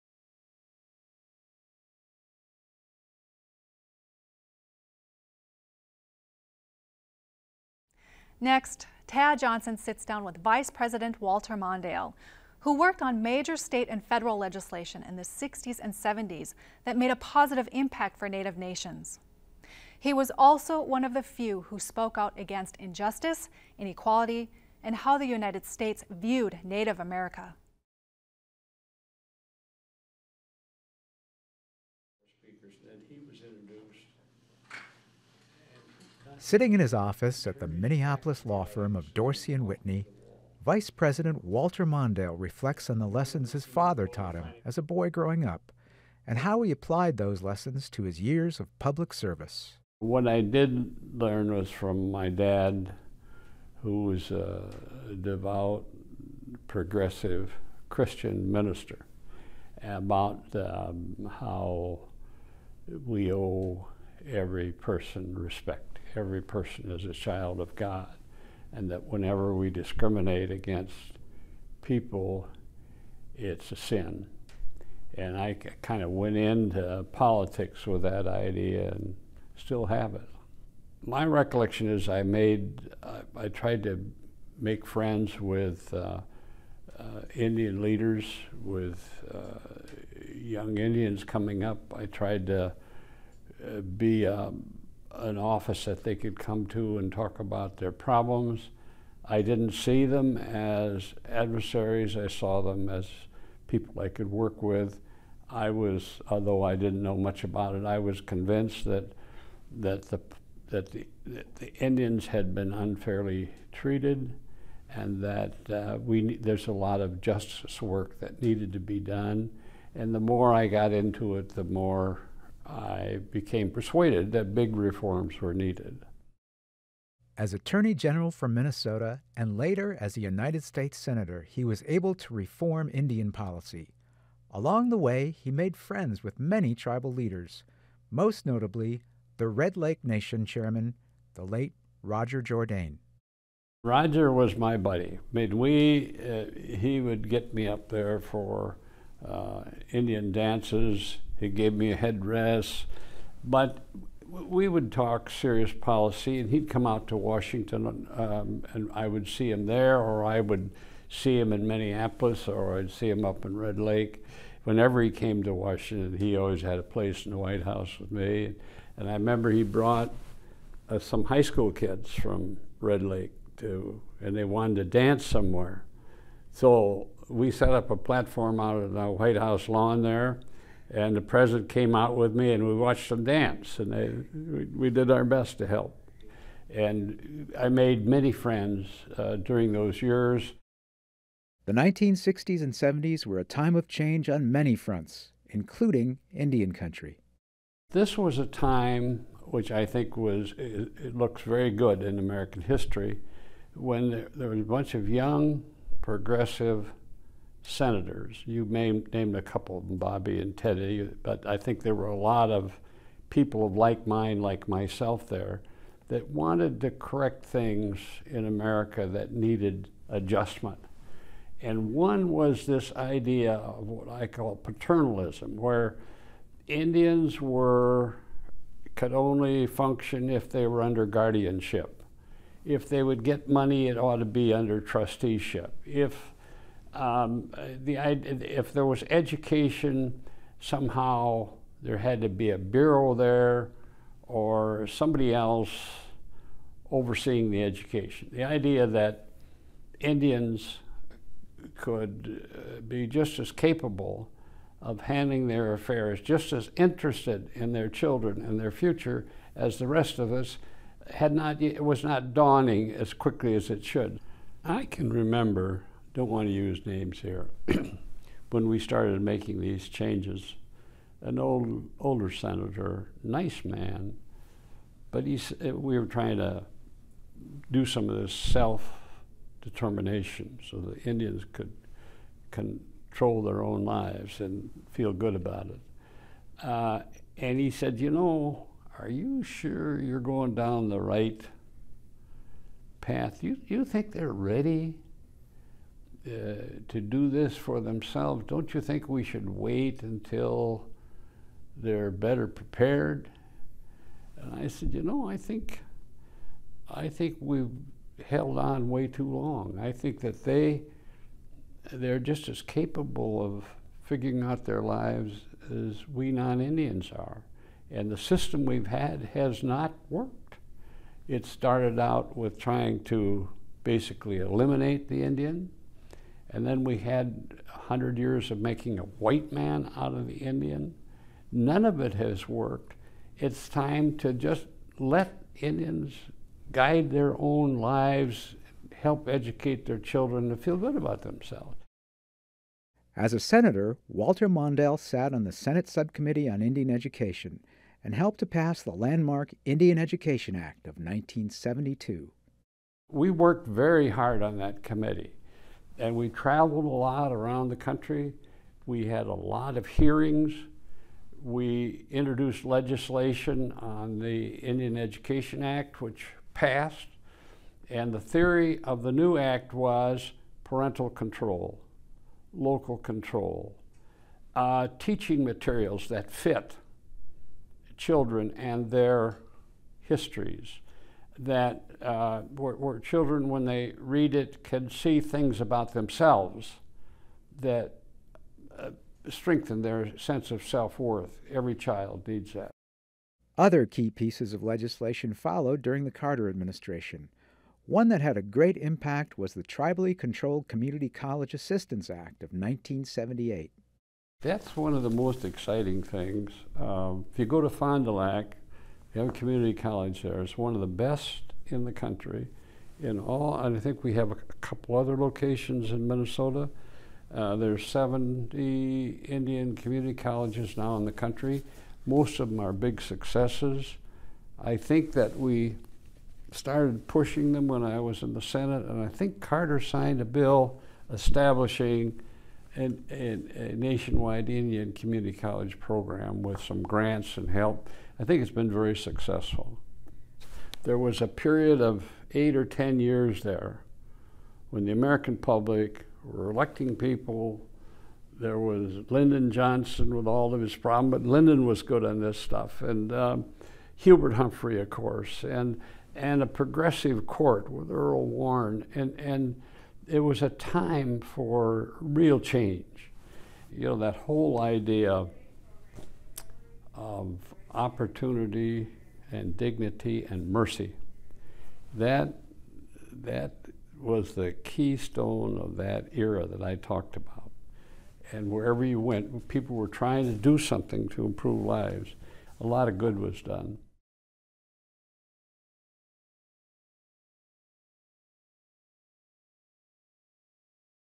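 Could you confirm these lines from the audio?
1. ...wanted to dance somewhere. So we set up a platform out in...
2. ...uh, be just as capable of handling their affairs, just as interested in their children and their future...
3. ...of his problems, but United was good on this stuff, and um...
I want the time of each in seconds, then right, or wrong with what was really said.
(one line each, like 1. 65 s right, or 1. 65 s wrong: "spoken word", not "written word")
1. 174 s right
2. 252 s right
3. 450 s wrong: "Lyndon", not "United".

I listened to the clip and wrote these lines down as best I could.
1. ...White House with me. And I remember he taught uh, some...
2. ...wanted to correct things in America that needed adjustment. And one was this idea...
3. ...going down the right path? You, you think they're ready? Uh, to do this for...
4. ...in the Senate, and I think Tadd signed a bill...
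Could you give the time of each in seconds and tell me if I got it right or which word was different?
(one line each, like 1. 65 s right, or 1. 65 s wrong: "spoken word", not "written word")
1. 167 s wrong: "brought", not "taught"
2. 216 s right
3. 290 s right
4. 428 s wrong: "Carter", not "Tadd".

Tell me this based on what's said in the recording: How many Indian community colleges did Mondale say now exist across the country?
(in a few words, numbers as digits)
70.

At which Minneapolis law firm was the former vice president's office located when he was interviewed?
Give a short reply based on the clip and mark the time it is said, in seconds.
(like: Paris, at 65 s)
Dorsey and Whitney, at 39 s.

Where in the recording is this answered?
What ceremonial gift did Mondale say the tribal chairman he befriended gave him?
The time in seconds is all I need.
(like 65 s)
151 s.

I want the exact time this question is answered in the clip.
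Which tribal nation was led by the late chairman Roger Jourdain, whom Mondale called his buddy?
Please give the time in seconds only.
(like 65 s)
139 s.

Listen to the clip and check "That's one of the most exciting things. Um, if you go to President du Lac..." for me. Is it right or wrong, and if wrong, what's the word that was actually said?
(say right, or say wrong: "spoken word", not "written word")
wrong: "Fond", not "President".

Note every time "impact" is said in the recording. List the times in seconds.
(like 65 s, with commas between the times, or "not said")
17 s, 398 s.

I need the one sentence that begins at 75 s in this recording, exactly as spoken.
And I kind of went into politics with that idea and still have it.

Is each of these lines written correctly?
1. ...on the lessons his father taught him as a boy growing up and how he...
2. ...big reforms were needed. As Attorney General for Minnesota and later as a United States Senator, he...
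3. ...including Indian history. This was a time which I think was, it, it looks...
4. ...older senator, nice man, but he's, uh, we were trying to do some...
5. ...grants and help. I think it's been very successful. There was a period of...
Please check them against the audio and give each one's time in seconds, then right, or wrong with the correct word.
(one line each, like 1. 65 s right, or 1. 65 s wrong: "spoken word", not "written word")
1. 42 s right
2. 124 s right
3. 195 s wrong: "country", not "history"
4. 271 s right
5. 436 s right.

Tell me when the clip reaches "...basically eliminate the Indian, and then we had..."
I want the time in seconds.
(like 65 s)
323 s.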